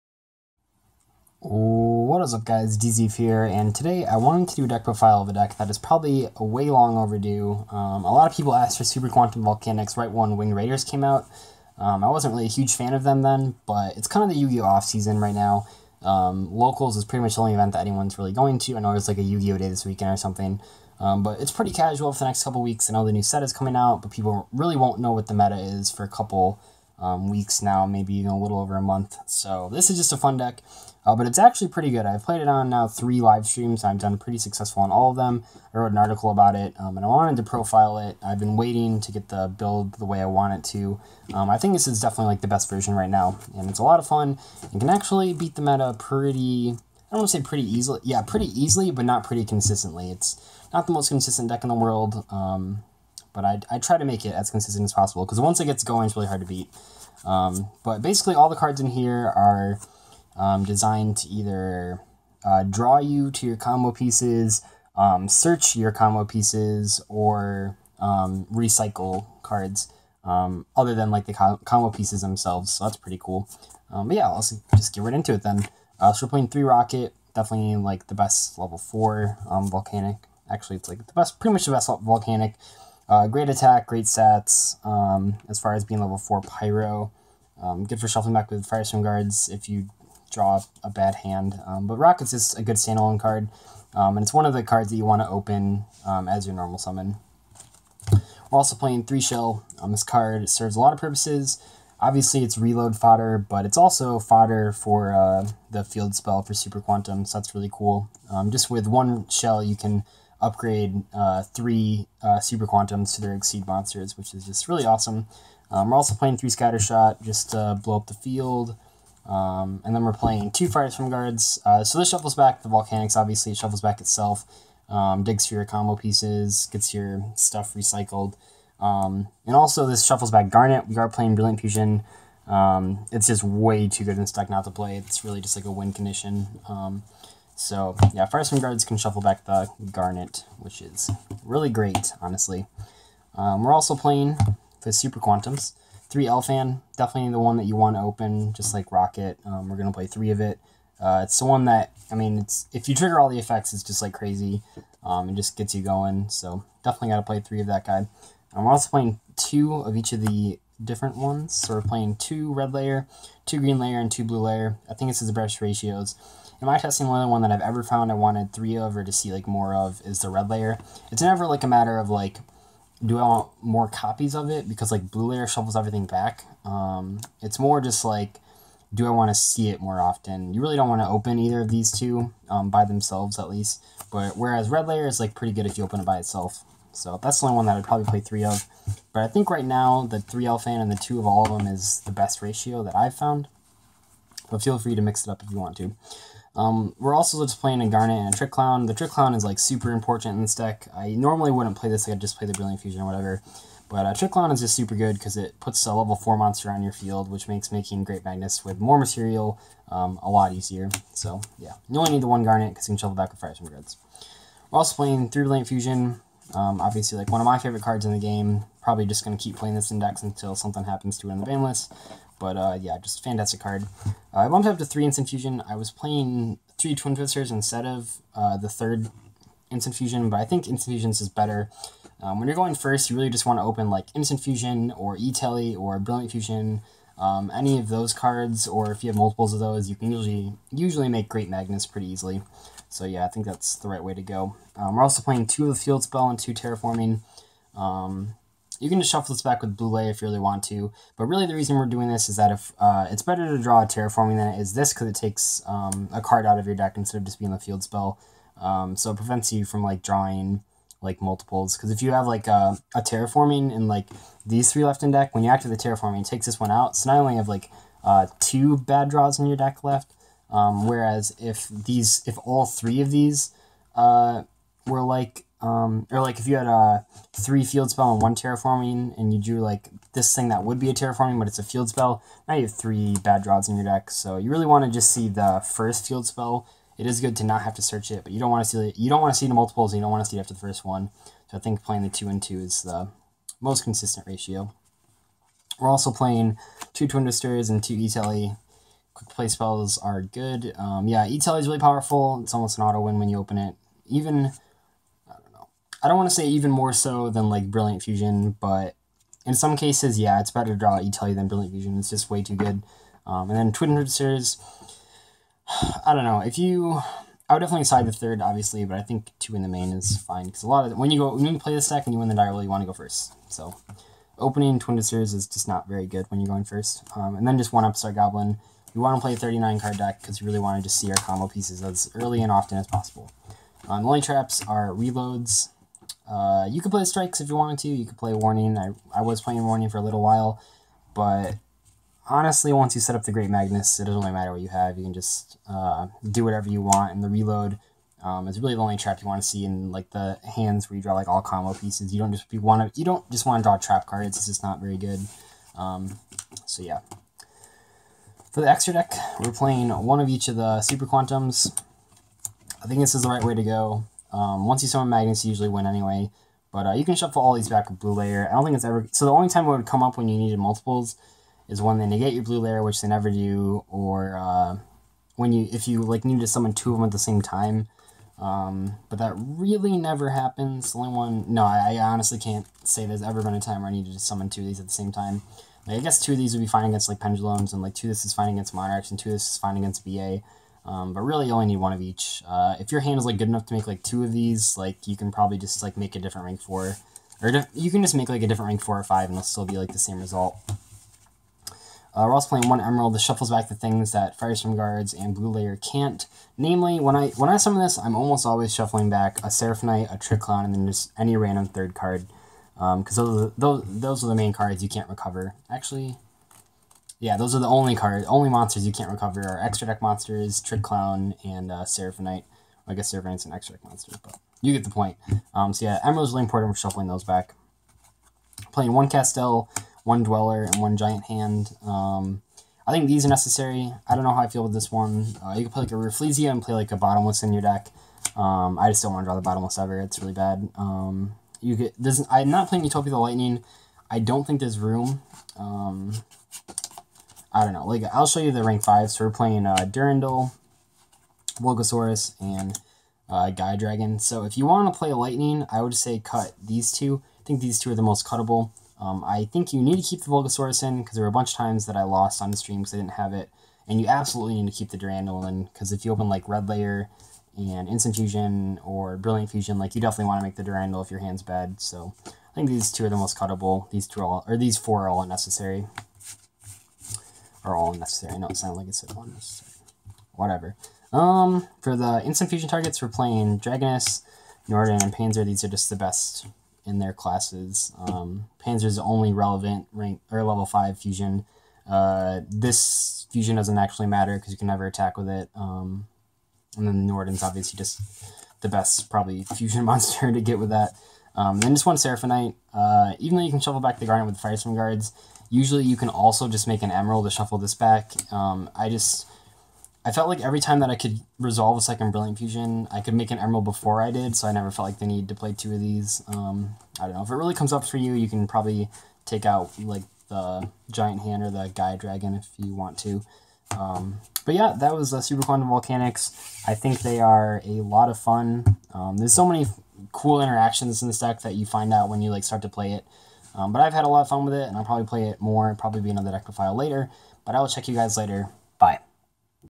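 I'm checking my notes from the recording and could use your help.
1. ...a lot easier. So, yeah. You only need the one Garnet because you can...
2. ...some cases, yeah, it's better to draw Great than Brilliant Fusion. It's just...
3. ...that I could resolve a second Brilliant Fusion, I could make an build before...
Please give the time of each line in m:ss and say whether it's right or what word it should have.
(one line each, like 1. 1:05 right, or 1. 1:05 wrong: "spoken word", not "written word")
1. 3:30 right
2. 5:09 wrong: "Etelli", not "Great"
3. 8:30 wrong: "emerald", not "build".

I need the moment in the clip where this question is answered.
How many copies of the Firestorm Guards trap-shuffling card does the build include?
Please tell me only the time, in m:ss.
2:00.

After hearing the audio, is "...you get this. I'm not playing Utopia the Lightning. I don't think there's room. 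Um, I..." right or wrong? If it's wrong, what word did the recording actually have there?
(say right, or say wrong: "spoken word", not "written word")
right.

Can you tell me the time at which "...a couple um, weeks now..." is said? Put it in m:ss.
0:26.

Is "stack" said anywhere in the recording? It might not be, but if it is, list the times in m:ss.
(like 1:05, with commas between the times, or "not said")
2:14, 5:21.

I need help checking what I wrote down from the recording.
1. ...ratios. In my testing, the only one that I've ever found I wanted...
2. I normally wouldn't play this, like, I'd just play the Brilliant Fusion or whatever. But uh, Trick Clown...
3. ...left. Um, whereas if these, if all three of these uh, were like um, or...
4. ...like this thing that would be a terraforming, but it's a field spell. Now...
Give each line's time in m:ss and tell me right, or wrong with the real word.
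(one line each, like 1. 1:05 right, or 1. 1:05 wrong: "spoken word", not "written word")
1. 2:45 right
2. 3:20 right
3. 4:29 right
4. 4:39 right.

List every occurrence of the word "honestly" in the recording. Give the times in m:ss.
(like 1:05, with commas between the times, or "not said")
2:22, 5:42, 6:21.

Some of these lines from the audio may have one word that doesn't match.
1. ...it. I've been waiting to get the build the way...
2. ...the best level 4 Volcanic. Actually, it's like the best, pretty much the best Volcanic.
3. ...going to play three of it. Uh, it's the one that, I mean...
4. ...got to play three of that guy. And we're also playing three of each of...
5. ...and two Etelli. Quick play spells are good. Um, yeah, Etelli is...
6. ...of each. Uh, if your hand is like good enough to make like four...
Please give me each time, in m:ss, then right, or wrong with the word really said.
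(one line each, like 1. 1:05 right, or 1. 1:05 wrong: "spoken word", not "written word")
1. 0:37 right
2. 1:18 right
3. 2:29 right
4. 2:37 wrong: "two", not "three"
5. 4:57 right
6. 6:31 wrong: "two", not "four".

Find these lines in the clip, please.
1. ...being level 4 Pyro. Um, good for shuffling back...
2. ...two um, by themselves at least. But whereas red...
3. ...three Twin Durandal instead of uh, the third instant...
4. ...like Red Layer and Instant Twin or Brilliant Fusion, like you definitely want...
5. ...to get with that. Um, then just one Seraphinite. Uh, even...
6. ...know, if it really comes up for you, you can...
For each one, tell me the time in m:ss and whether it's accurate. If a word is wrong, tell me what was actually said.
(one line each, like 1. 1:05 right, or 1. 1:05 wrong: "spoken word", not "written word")
1. 1:25 right
2. 3:01 right
3. 3:46 wrong: "Twisters", not "Durandal"
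4. 7:46 wrong: "Fusion", not "Twin"
5. 8:20 right
6. 8:37 right.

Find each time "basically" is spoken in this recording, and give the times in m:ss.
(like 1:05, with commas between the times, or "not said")
0:58.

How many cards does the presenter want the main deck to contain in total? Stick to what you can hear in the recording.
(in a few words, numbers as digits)
39.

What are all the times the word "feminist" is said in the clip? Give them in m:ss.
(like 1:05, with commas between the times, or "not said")
not said.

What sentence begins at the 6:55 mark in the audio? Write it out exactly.
Actually, yeah, those are the only cards, only monsters you can't recover are extra deck monsters, Trick Clown, and uh, Seraphinite.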